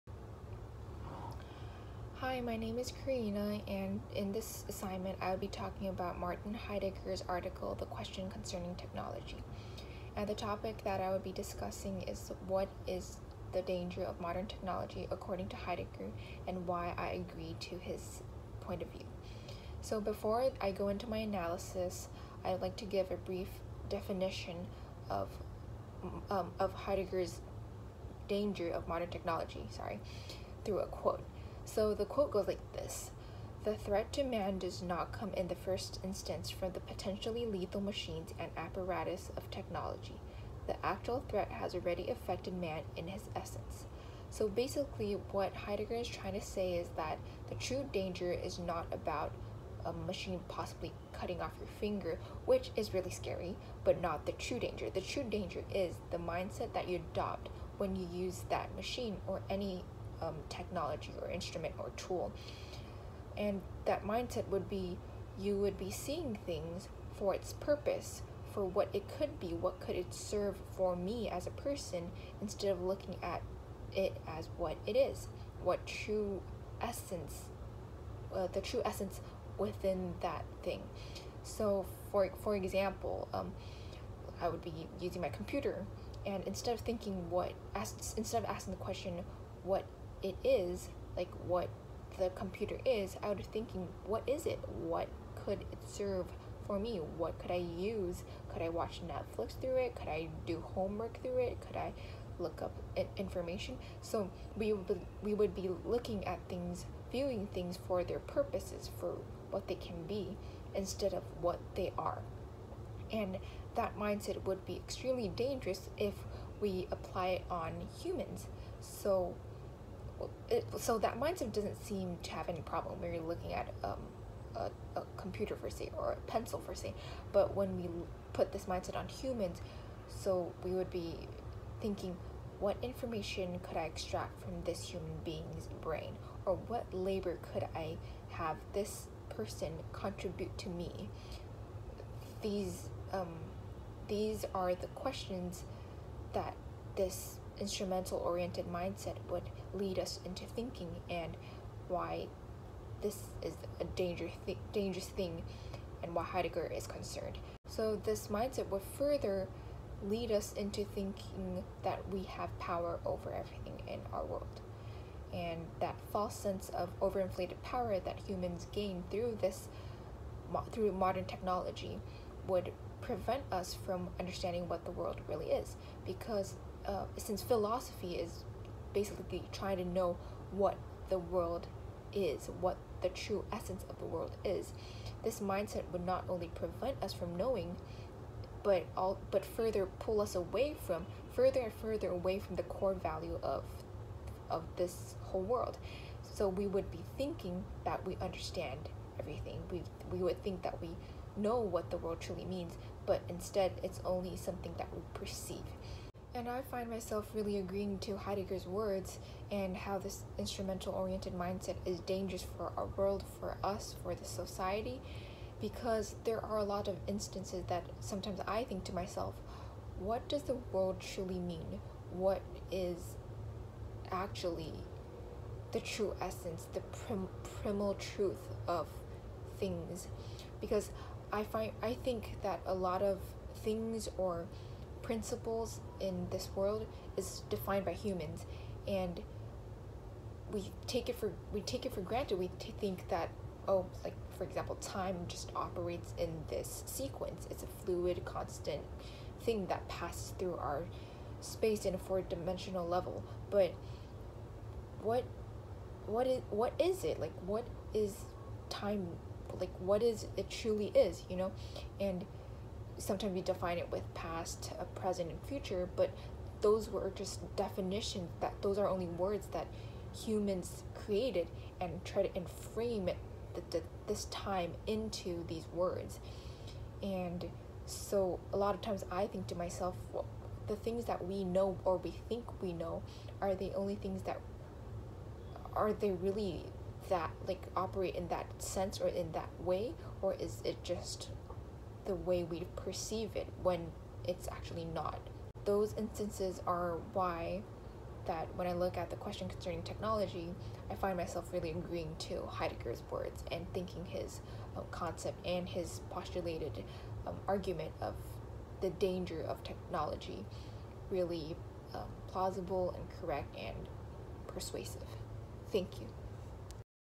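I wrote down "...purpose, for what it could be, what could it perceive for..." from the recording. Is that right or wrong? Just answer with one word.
wrong.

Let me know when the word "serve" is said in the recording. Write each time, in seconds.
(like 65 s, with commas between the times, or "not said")
70 s, 95 s.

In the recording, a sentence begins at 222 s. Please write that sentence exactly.
What is actually the true essence, the prim- primal truth of things?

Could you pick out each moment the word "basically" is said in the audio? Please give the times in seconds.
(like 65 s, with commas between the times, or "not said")
44 s, 178 s.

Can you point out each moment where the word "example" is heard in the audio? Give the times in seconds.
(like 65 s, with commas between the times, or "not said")
82 s, 244 s.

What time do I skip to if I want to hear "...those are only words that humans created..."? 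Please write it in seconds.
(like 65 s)
268 s.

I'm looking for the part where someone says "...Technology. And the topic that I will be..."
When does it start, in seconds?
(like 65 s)
8 s.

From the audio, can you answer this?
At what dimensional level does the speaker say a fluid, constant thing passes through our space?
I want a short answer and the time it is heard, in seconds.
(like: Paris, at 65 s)
four-dimensional, at 251 s.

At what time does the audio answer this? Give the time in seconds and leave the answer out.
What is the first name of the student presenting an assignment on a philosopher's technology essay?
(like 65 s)
3 s.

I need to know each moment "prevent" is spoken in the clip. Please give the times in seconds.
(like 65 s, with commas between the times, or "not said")
172 s, 186 s.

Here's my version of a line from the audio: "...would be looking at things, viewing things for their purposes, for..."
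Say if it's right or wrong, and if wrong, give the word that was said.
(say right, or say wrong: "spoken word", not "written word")
right.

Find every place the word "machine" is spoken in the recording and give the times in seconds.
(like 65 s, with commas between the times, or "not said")
37 s, 49 s, 58 s.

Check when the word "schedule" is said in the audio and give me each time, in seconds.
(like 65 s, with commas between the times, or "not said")
not said.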